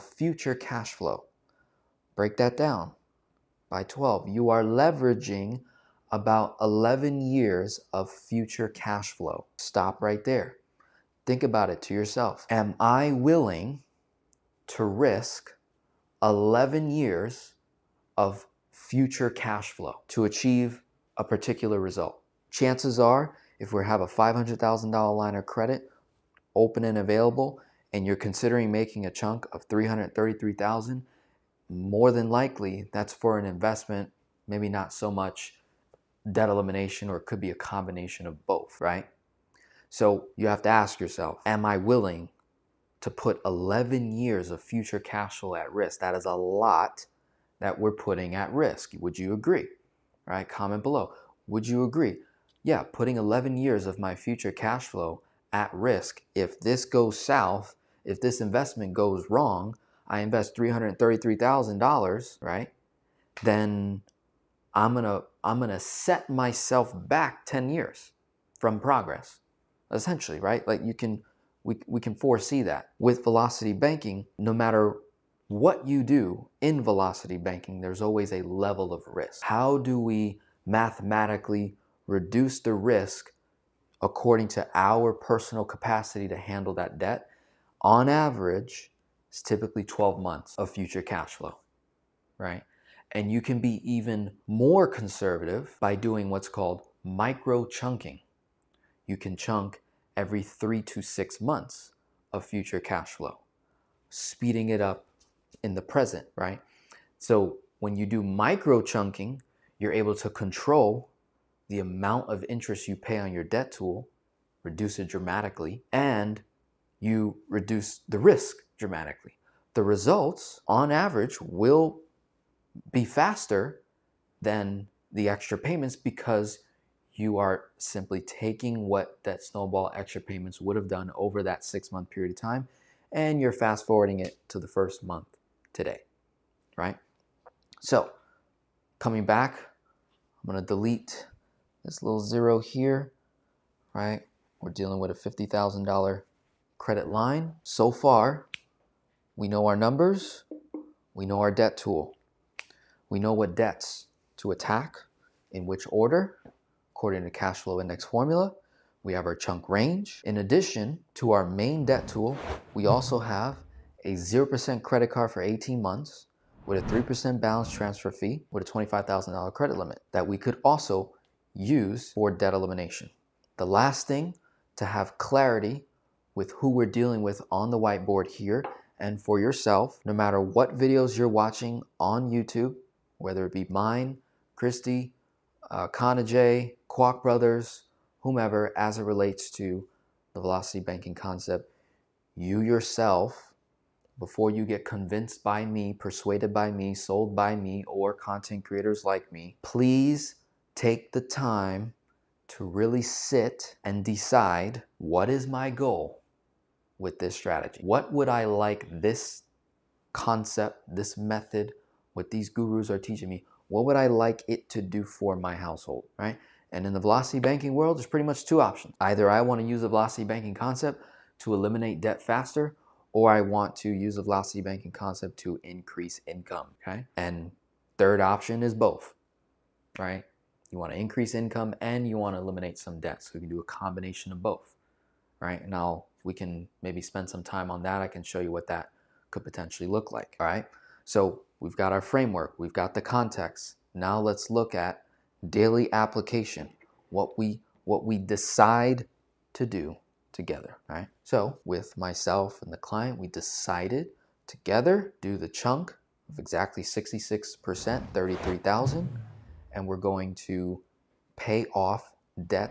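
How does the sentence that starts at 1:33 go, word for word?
And you can be even more conservative by doing what's called micro chunking.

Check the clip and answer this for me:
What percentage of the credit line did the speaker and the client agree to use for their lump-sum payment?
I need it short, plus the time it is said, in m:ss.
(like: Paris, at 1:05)
66%, at 4:16.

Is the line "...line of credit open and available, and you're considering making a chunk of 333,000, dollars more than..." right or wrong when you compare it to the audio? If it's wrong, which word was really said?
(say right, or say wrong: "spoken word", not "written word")
right.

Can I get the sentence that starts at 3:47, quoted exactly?
And third option is both, right?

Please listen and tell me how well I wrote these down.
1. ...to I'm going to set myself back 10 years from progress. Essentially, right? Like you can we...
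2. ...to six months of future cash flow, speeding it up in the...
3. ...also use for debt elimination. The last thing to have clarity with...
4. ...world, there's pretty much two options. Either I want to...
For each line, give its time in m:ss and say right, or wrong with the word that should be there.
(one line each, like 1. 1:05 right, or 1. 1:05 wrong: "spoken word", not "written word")
1. 1:05 right
2. 1:40 right
3. 2:50 right
4. 3:37 right.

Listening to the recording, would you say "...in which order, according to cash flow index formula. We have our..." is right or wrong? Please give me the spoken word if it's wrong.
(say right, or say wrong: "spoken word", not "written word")
right.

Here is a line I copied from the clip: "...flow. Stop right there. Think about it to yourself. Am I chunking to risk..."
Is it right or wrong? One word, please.
wrong.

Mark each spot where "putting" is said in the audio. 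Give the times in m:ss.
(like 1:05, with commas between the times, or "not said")
0:47, 0:52.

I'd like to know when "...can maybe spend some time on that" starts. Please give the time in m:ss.
3:56.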